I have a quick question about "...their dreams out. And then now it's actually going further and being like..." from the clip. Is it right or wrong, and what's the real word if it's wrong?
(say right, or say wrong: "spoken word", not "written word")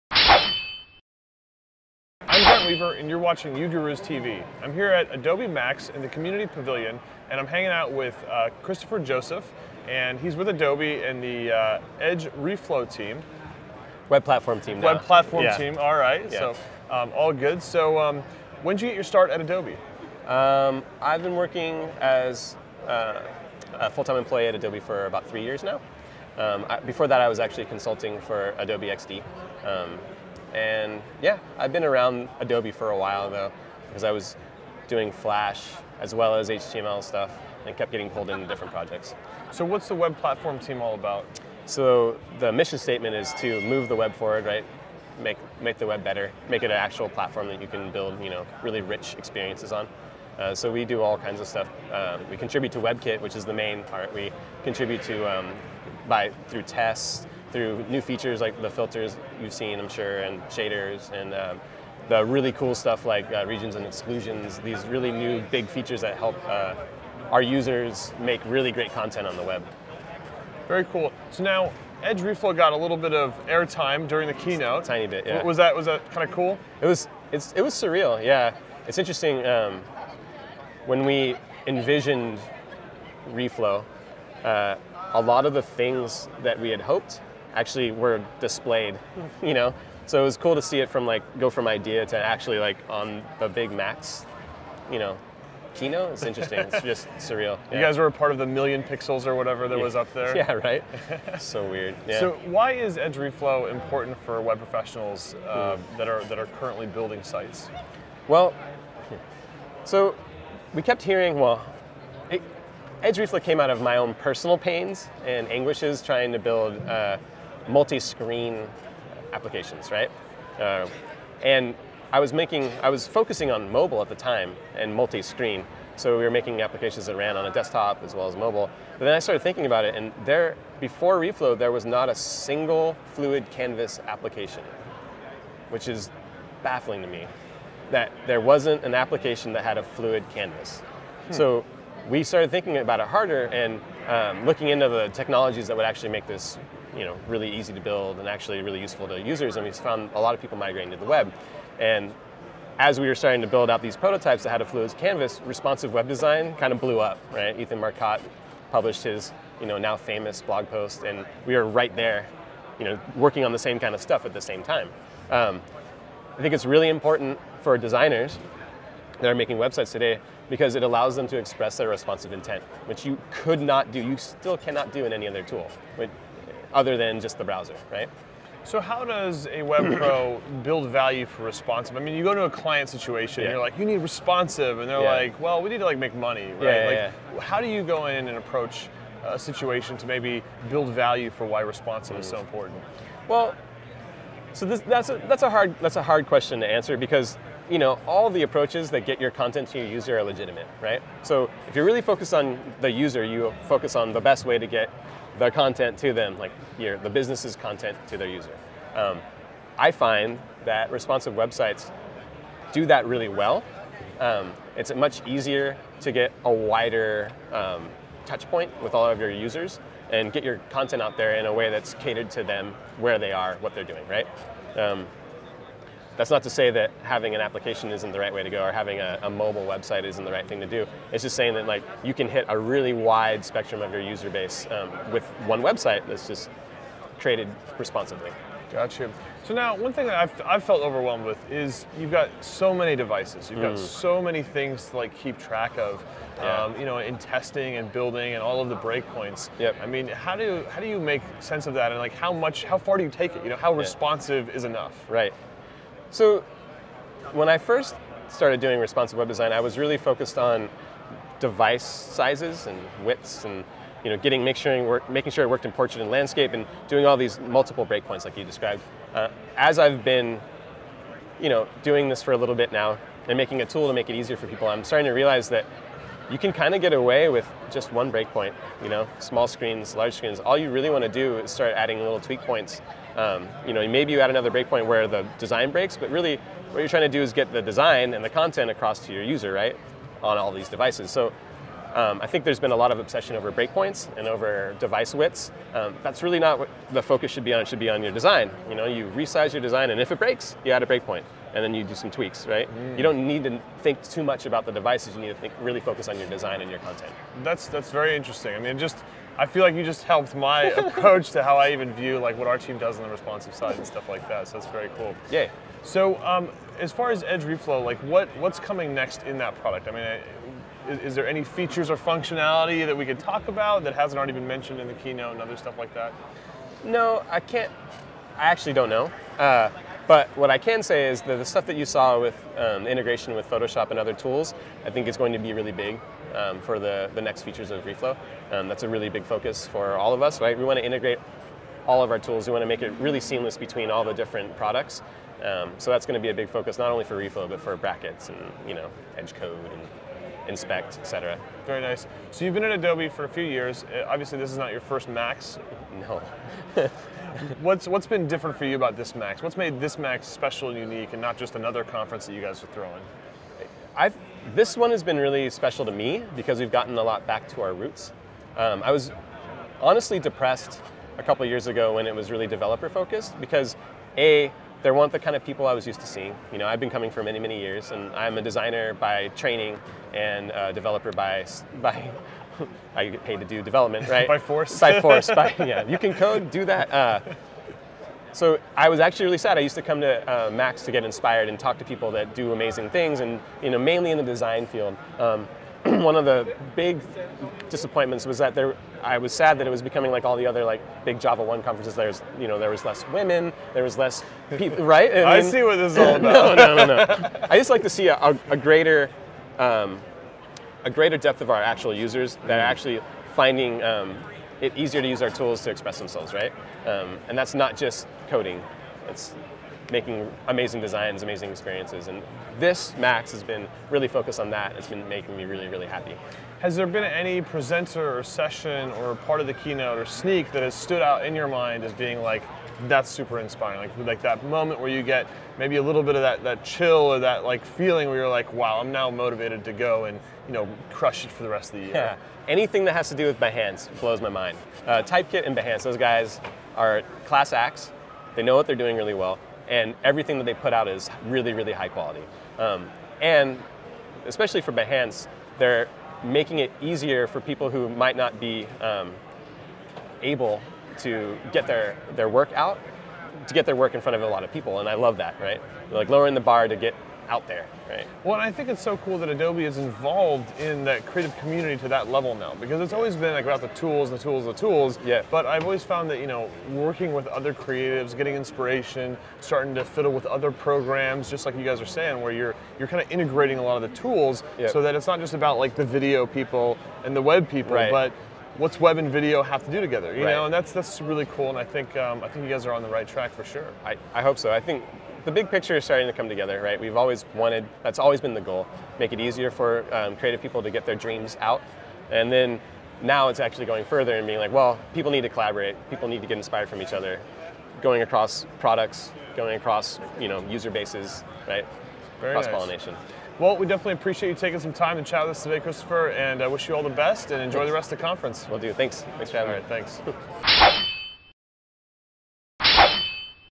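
right.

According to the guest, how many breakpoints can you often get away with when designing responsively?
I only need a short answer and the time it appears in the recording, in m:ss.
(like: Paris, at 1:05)
1, at 4:37.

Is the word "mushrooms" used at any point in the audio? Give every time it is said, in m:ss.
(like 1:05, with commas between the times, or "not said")
not said.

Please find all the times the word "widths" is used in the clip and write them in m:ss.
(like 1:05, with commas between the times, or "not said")
4:23, 4:55.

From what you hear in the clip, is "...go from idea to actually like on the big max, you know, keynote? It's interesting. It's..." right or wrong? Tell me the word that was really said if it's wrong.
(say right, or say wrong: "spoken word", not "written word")
right.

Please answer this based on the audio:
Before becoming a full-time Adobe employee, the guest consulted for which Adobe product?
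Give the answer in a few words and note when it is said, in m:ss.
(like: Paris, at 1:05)
Adobe XD, at 0:28.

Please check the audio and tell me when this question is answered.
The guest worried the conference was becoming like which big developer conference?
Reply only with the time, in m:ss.
6:41.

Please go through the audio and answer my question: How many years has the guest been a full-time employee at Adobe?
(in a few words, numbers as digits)
3.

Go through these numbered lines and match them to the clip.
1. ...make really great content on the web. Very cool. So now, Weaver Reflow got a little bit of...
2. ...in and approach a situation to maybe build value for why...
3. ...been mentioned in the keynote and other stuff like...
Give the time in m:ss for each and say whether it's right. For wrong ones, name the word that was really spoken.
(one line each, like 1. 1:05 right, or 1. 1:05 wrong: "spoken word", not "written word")
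1. 1:08 wrong: "Edge", not "Weaver"
2. 3:08 right
3. 5:24 right.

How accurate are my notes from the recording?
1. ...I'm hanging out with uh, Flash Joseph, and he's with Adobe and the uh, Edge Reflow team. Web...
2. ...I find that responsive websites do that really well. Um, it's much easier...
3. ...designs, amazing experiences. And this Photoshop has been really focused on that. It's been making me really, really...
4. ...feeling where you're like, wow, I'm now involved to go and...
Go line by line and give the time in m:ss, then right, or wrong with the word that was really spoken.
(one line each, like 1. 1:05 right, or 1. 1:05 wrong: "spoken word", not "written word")
1. 0:07 wrong: "Kristofer", not "Flash"
2. 3:29 right
3. 7:00 wrong: "Max", not "Photoshop"
4. 7:17 wrong: "motivated", not "involved".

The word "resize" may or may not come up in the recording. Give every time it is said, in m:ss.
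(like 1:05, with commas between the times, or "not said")
4:59.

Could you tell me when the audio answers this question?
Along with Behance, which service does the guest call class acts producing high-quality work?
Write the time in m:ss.
7:25.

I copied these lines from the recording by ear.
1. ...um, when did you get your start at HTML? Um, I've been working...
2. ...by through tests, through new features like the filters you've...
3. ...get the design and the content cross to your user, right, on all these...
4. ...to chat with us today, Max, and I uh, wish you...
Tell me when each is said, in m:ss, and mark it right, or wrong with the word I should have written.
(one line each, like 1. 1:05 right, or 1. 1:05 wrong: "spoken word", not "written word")
1. 0:17 wrong: "Adobe", not "HTML"
2. 0:56 right
3. 4:47 wrong: "across", not "cross"
4. 8:34 wrong: "Kristofer", not "Max".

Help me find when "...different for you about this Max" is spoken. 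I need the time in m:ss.
5:58.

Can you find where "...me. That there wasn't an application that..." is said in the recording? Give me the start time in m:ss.
2:17.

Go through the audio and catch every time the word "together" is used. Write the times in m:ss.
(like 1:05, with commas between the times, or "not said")
8:09, 8:16.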